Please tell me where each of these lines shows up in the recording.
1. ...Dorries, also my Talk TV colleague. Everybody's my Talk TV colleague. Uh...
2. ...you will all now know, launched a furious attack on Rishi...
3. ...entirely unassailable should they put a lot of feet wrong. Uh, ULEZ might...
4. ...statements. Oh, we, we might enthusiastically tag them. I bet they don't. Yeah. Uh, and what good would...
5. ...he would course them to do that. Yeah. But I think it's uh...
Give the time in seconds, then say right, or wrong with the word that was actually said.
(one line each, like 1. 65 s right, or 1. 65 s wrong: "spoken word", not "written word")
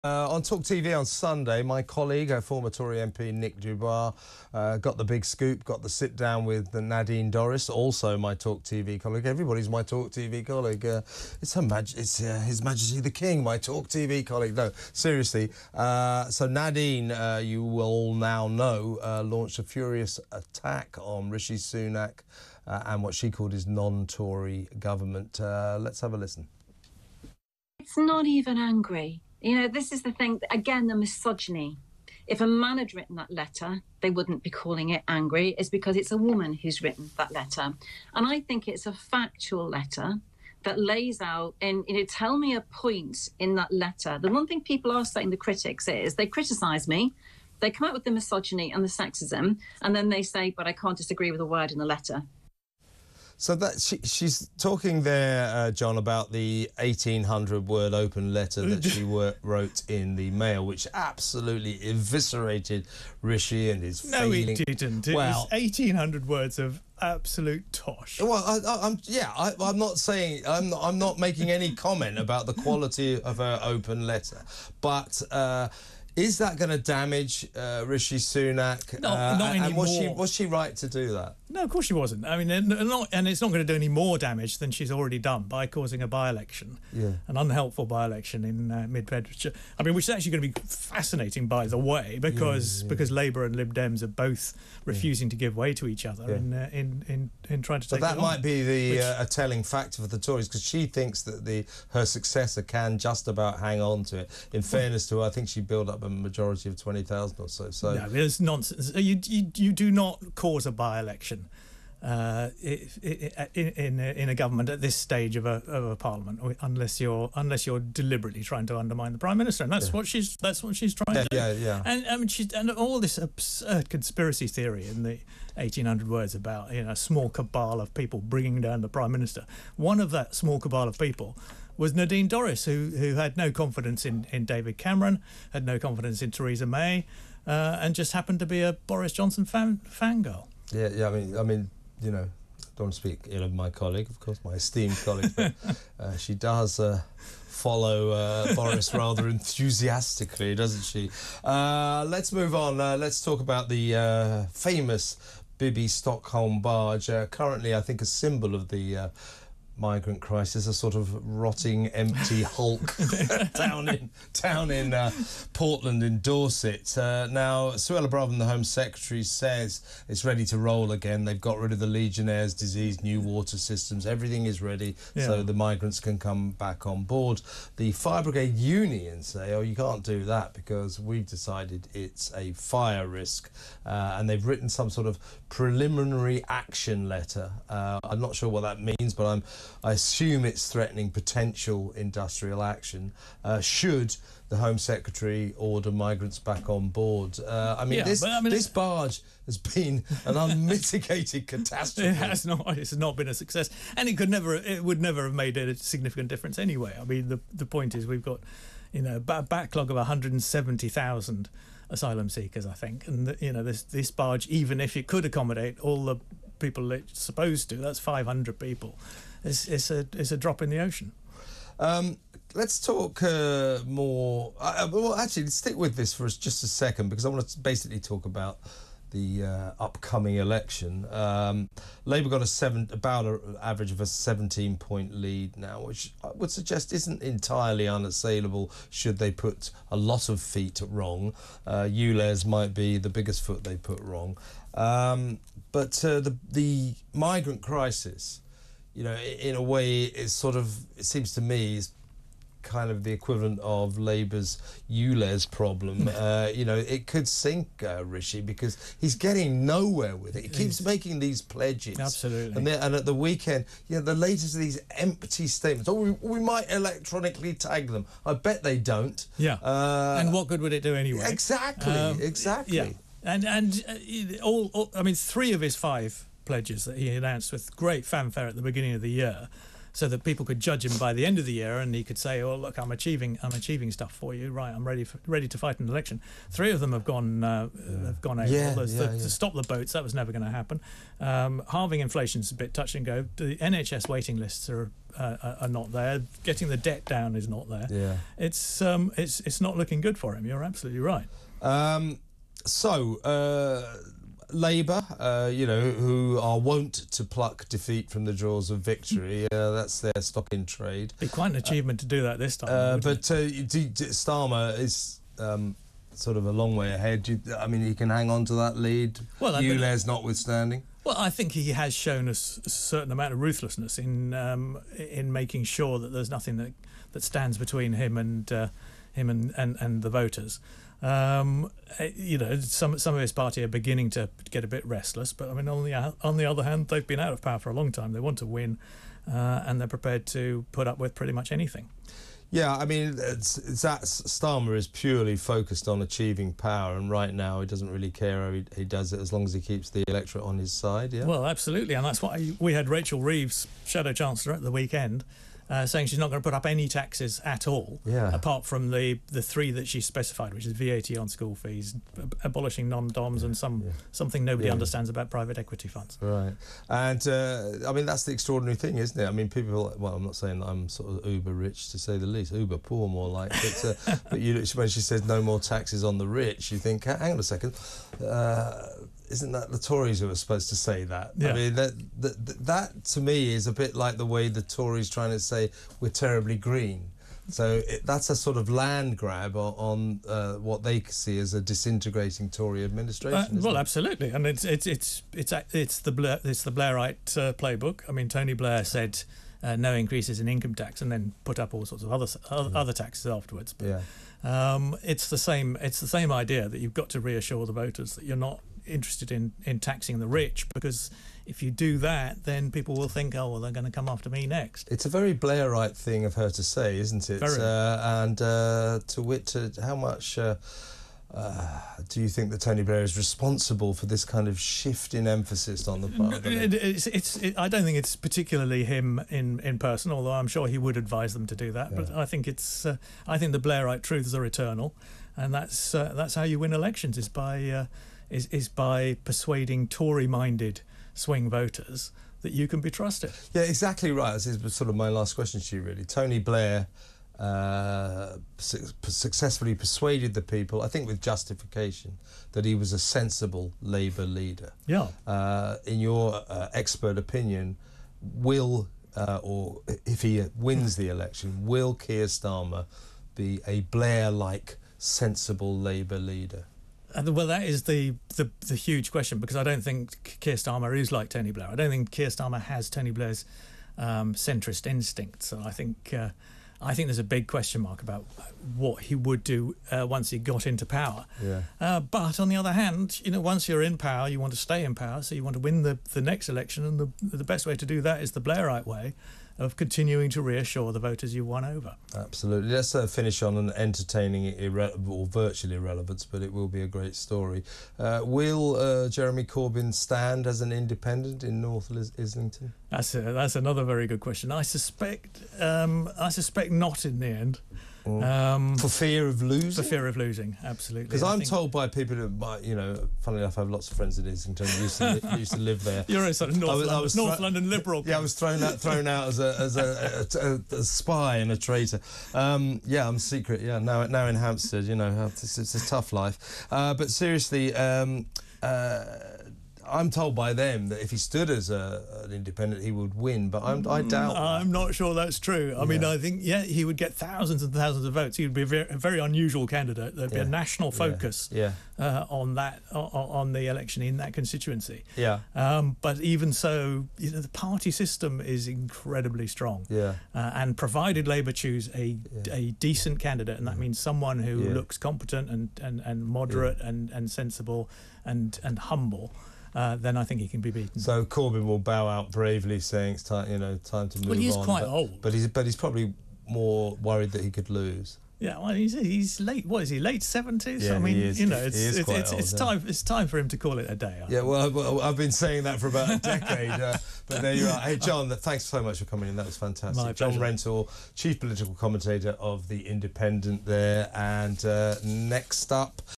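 1. 7 s right
2. 17 s right
3. 237 s right
4. 265 s wrong: "electronically", not "enthusiastically"
5. 430 s wrong: "advise", not "course".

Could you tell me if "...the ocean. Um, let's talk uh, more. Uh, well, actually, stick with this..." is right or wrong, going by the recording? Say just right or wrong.
right.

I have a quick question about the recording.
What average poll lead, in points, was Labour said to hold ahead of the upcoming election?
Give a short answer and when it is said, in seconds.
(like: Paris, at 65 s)
17, at 234 s.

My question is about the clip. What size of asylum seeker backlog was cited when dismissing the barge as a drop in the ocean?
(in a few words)
170,000.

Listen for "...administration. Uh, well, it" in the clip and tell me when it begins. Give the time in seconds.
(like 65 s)
392 s.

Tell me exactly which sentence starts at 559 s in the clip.
Uh, then I think he can be beaten.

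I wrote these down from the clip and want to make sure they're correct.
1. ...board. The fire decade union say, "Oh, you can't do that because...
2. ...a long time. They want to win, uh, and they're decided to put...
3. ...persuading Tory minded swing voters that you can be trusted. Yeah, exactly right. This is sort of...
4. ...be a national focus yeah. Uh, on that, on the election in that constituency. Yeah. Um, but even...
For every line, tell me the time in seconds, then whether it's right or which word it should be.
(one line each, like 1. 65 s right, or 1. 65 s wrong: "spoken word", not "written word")
1. 177 s wrong: "brigade", not "decade"
2. 337 s wrong: "prepared", not "decided"
3. 439 s right
4. 540 s right.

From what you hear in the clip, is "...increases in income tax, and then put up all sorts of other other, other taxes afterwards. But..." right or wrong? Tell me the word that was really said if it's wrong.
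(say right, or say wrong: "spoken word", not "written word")
right.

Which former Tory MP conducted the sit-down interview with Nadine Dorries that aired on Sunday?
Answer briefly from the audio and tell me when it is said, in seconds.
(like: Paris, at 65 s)
Nick de Bois, at 3 s.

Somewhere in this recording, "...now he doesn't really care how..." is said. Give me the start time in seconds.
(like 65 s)
347 s.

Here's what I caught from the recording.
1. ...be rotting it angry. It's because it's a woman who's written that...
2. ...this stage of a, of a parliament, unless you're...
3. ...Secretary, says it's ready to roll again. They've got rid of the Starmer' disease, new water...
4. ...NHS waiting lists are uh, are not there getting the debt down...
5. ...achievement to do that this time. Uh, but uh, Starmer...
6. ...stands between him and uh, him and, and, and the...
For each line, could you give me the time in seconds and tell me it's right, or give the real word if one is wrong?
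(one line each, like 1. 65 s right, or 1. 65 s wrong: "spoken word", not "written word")
1. 34 s wrong: "calling", not "rotting"
2. 114 s right
3. 168 s wrong: "Legionnaires", not "Starmer"
4. 293 s right
5. 311 s right
6. 327 s right.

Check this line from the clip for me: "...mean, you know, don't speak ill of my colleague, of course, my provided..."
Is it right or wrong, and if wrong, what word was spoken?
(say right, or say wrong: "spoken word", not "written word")
wrong: "esteemed", not "provided".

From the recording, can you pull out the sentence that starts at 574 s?
I yeah, well, well, I've been saying that for about a decade, uh, but there you are.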